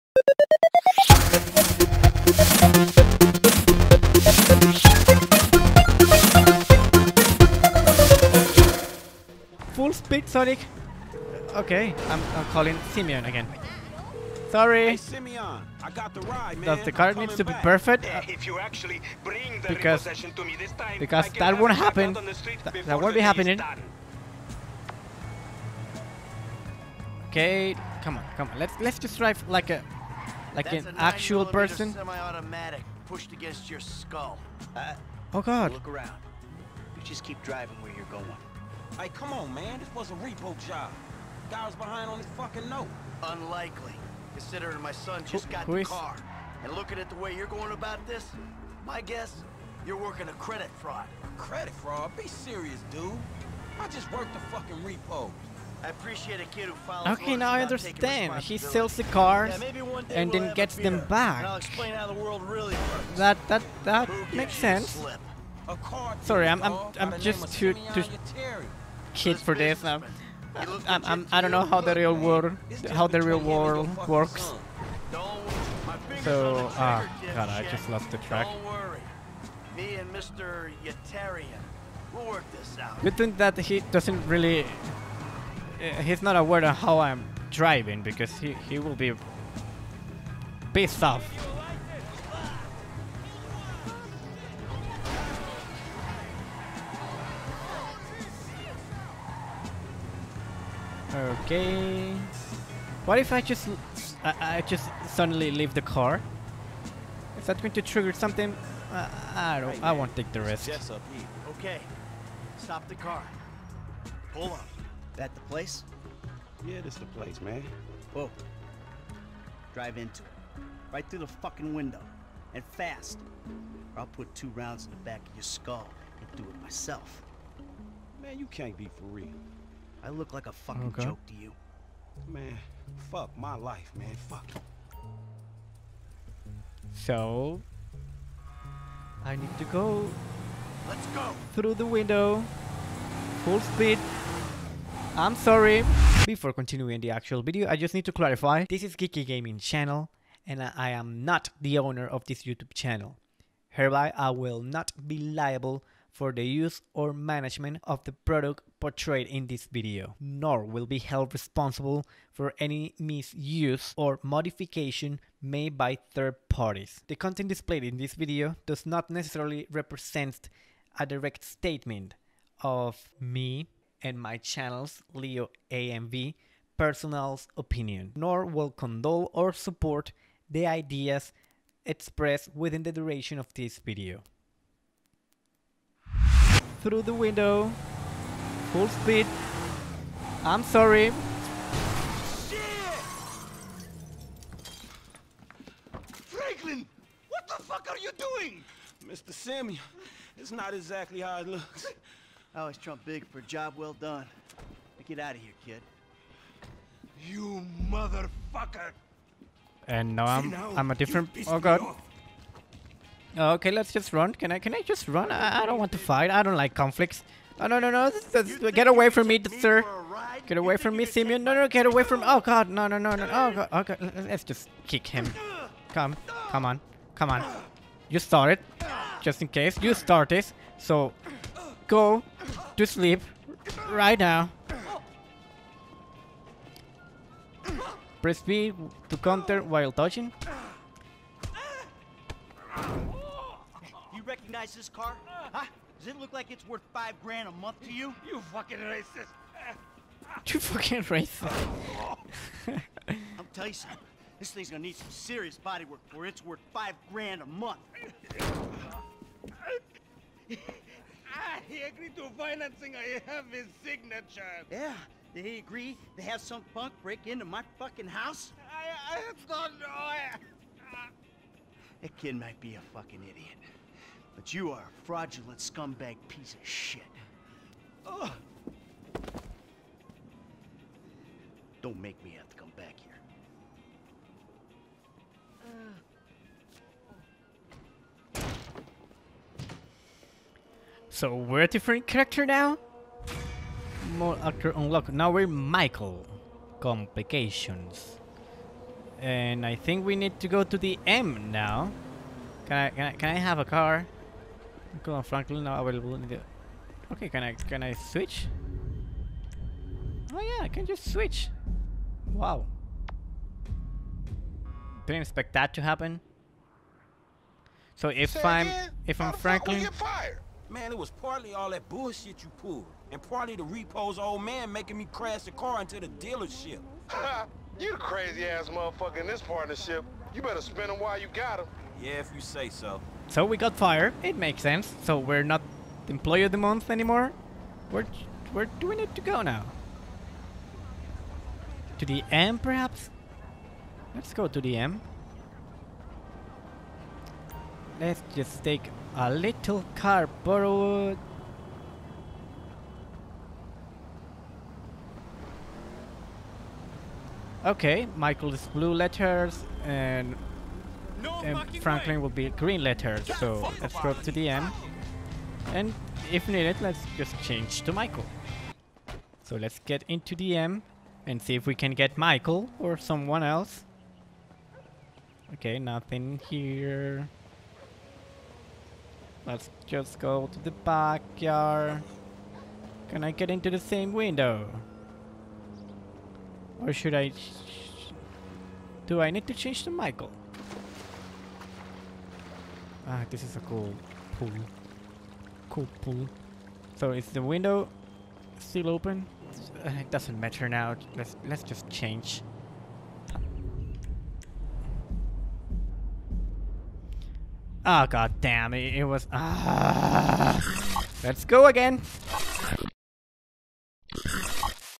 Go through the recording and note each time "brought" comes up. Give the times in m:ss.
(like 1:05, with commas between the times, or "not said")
not said.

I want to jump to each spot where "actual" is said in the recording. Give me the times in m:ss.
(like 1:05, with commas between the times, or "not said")
0:30, 2:27.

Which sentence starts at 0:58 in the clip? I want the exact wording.
He sells the cars yeah, and then we'll gets them back.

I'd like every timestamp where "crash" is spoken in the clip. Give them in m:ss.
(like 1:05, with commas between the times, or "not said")
5:25.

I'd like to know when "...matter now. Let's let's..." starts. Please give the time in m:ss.
6:40.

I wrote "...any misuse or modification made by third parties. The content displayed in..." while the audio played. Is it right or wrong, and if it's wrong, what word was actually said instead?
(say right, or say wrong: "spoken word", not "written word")
right.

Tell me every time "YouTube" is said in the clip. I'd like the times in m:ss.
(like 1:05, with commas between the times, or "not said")
2:32.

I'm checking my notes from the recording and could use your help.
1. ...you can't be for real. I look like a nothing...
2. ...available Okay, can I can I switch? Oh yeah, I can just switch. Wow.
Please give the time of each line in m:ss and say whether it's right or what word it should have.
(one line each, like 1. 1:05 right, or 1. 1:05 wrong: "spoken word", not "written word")
1. 2:08 wrong: "fucking", not "nothing"
2. 5:05 right.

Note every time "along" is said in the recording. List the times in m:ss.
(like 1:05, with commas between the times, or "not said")
not said.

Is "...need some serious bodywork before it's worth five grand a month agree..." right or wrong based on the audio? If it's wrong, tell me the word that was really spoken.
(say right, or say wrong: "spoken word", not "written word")
right.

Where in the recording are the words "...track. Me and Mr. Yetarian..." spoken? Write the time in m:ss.
1:18.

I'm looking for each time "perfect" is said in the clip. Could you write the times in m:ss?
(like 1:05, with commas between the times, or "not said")
0:17.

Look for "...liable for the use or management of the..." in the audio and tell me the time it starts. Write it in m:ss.
2:35.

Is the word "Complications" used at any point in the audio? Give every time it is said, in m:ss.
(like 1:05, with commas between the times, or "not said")
4:56.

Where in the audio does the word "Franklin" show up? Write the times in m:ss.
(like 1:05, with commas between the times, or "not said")
3:16, 5:05, 5:19, 6:01.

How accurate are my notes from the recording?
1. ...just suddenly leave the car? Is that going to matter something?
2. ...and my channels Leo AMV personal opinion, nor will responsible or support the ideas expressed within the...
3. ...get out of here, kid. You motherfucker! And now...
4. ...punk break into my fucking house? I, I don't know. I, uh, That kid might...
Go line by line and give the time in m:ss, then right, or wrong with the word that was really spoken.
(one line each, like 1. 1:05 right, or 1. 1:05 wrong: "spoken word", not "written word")
1. 1:44 wrong: "trigger", not "matter"
2. 2:54 wrong: "condole", not "responsible"
3. 3:25 right
4. 4:26 right.